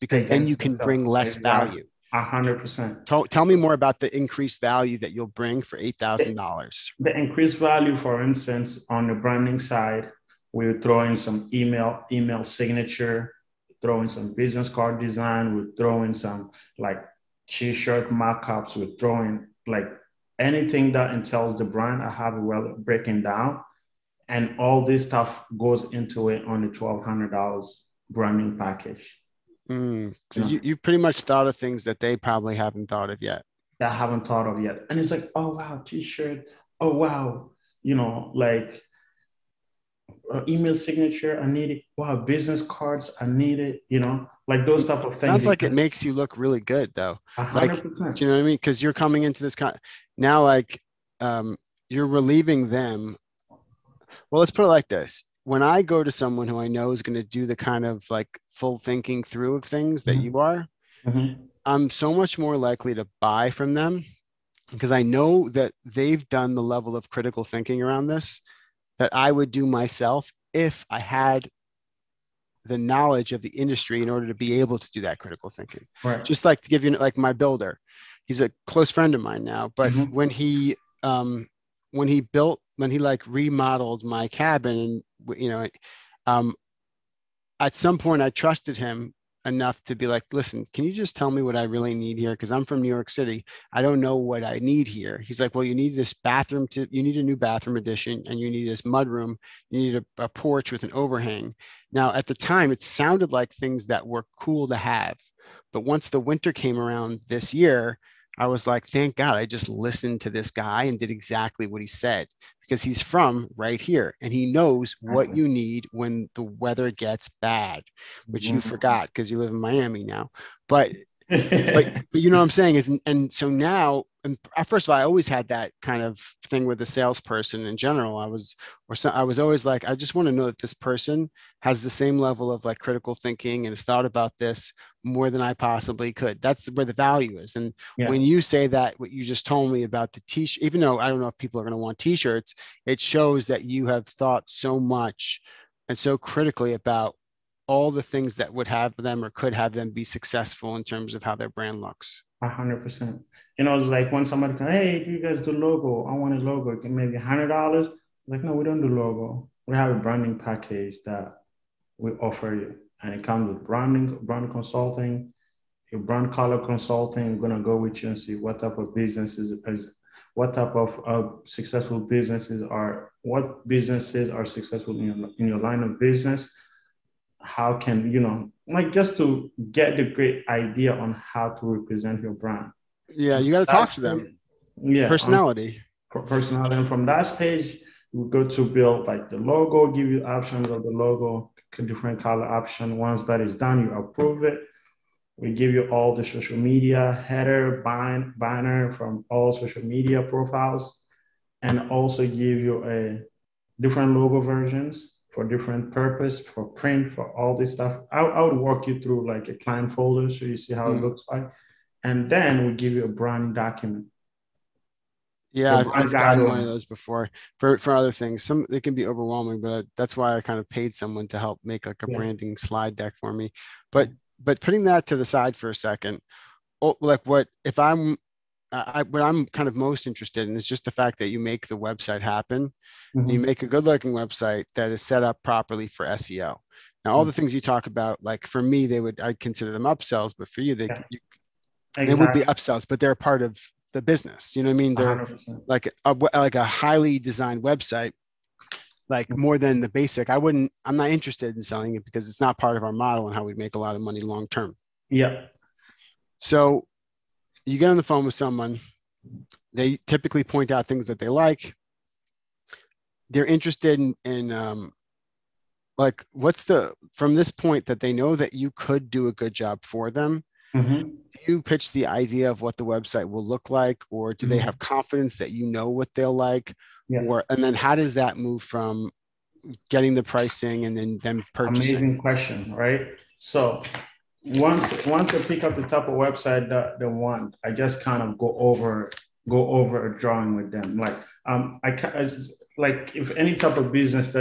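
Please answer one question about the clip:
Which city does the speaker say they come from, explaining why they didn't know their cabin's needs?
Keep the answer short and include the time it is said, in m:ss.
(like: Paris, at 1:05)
New York City, at 1:32.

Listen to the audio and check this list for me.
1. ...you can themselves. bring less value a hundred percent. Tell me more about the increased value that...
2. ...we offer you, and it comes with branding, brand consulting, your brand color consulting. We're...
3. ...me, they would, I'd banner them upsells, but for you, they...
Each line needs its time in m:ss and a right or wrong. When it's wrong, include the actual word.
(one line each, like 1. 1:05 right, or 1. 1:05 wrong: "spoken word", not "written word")
1. 0:00 right
2. 2:41 right
3. 3:58 wrong: "consider", not "banner".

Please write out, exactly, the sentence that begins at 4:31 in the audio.
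Do you pitch the idea of what the website will look like, or do mm-hmm.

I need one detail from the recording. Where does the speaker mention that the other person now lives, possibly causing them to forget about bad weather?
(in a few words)
Miami.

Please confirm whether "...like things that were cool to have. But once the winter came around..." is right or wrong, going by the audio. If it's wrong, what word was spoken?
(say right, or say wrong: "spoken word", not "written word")
right.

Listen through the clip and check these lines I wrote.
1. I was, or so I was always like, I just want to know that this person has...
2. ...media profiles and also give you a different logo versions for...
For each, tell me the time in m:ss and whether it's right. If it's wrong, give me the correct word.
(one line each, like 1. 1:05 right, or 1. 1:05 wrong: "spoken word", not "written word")
1. 2:08 right
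2. 3:19 right.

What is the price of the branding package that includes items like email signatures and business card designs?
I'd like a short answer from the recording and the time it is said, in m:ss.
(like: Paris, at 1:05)
$1,200, at 0:26.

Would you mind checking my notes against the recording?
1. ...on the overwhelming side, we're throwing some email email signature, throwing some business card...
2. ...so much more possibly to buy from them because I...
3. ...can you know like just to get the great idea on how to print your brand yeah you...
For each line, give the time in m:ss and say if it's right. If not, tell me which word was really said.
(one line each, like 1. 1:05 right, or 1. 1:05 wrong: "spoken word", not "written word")
1. 0:08 wrong: "branding", not "overwhelming"
2. 1:01 wrong: "likely", not "possibly"
3. 2:57 wrong: "represent", not "print".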